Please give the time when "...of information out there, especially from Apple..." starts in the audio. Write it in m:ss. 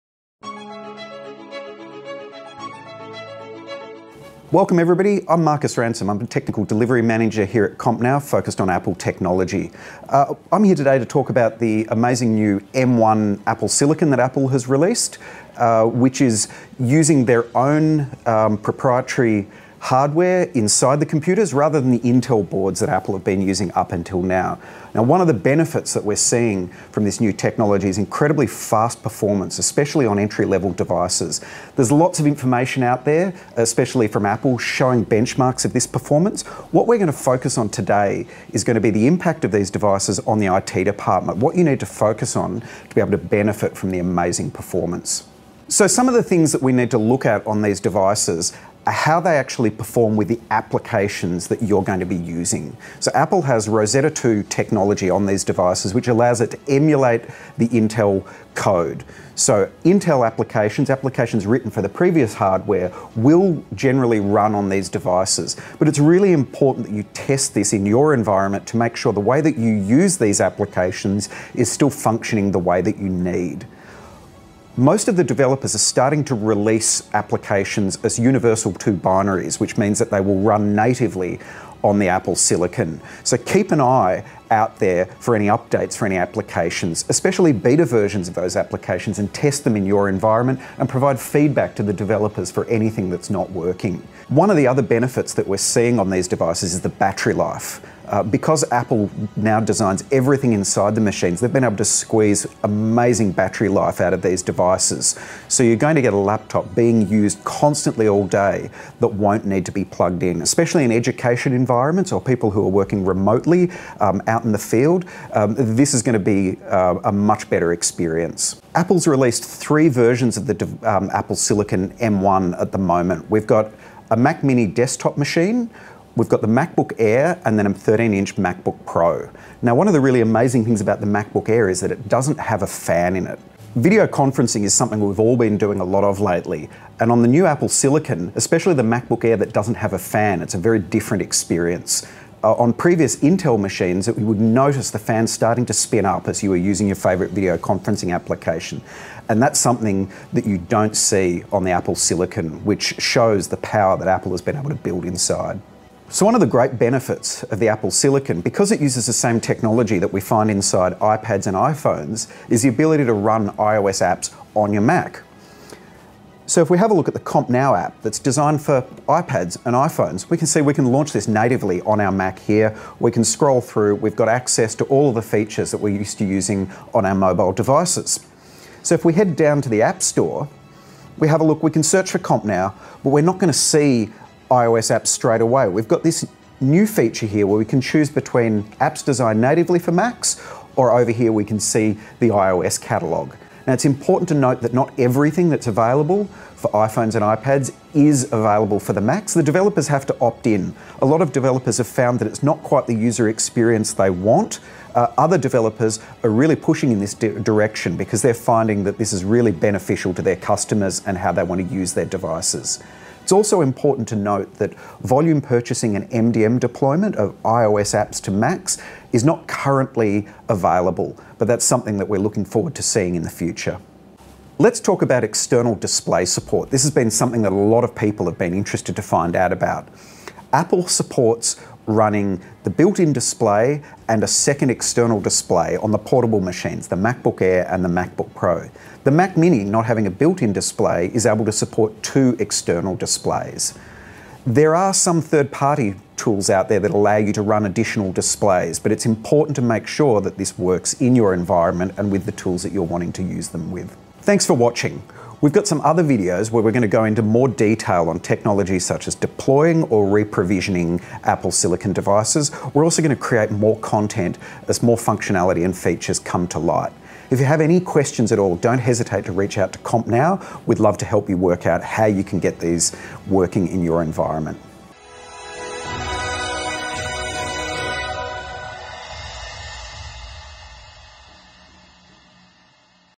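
0:32.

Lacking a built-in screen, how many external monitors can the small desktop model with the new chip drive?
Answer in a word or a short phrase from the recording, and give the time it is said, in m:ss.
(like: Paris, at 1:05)
2, at 4:02.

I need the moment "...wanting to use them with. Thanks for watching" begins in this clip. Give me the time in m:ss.
4:12.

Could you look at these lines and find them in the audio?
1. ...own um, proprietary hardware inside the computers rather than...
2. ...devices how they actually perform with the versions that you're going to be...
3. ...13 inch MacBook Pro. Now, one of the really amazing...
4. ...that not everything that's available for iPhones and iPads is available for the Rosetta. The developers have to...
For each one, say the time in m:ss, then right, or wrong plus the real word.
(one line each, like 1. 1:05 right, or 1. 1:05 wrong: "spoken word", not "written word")
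1. 0:17 right
2. 0:47 wrong: "applications", not "versions"
3. 2:07 right
4. 3:14 wrong: "Macs", not "Rosetta".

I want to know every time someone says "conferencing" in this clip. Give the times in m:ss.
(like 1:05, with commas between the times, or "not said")
2:14, 2:27.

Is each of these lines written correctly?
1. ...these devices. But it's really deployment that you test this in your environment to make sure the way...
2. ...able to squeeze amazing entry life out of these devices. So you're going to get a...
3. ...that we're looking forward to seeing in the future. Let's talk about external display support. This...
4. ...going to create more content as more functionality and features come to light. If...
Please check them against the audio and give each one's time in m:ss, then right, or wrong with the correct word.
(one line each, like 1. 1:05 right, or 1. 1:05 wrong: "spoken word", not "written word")
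1. 1:04 wrong: "important", not "deployment"
2. 1:41 wrong: "battery", not "entry"
3. 3:41 right
4. 4:23 right.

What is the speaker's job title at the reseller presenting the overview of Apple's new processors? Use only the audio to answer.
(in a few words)
Technical delivery manager.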